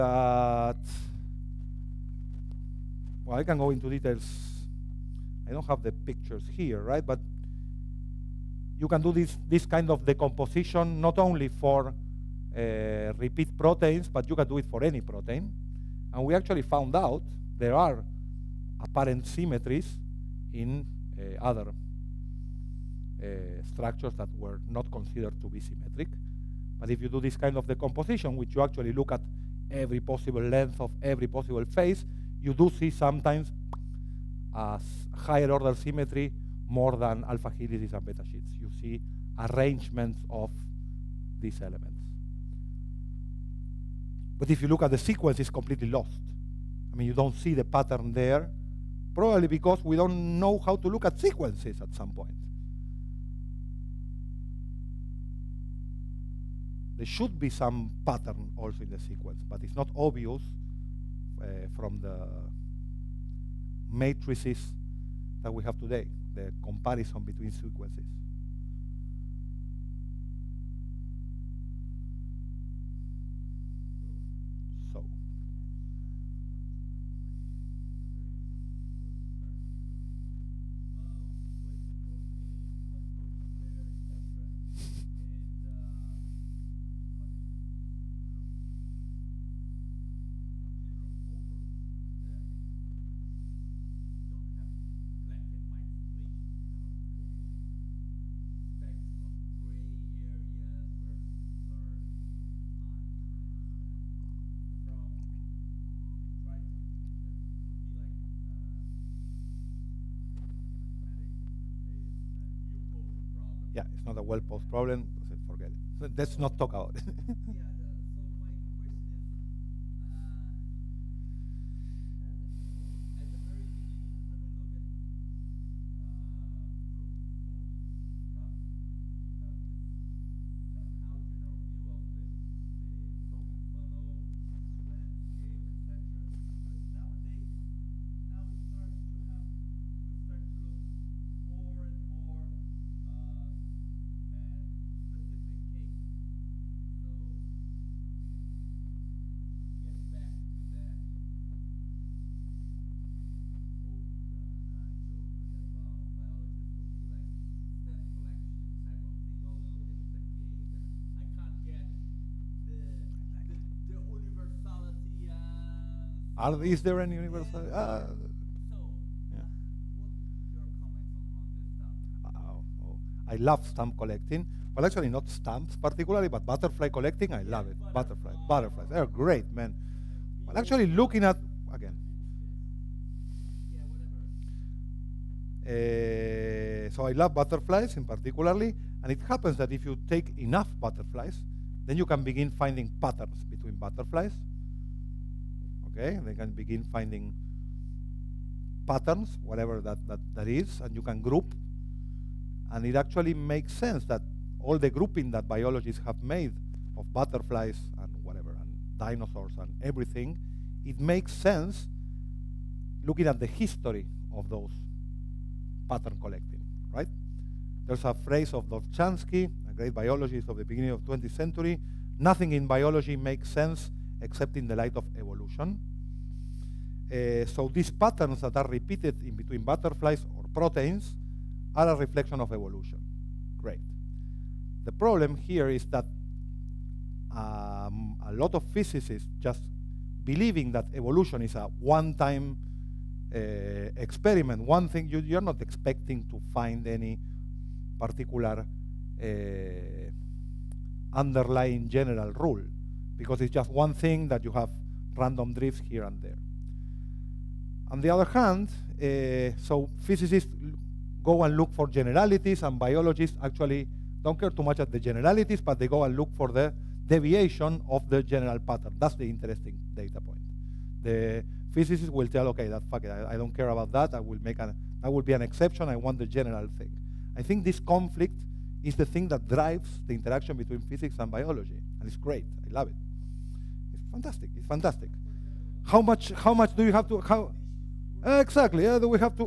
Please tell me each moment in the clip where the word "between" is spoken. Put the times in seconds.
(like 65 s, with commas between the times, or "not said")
67 s, 193 s, 229 s, 280 s.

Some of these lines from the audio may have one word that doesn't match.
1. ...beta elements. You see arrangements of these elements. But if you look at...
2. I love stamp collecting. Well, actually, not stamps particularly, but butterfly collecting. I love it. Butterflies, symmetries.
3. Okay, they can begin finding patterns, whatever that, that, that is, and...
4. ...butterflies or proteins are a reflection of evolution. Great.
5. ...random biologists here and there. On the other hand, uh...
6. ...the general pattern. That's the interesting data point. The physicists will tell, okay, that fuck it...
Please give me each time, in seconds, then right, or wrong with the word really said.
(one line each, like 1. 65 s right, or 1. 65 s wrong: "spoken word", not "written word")
1. 38 s wrong: "sheets", not "elements"
2. 173 s wrong: "butterflies", not "symmetries"
3. 195 s right
4. 229 s right
5. 255 s wrong: "drifts", not "biologists"
6. 268 s right.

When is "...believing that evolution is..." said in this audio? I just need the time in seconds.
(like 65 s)
240 s.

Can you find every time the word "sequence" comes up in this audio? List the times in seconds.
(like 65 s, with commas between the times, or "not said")
44 s, 51 s, 58 s, 67 s.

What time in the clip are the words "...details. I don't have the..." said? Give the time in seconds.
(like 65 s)
3 s.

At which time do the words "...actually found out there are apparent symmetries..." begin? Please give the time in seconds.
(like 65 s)
16 s.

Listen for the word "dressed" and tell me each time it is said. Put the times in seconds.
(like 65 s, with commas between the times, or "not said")
not said.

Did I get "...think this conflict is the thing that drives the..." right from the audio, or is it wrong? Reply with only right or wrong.
right.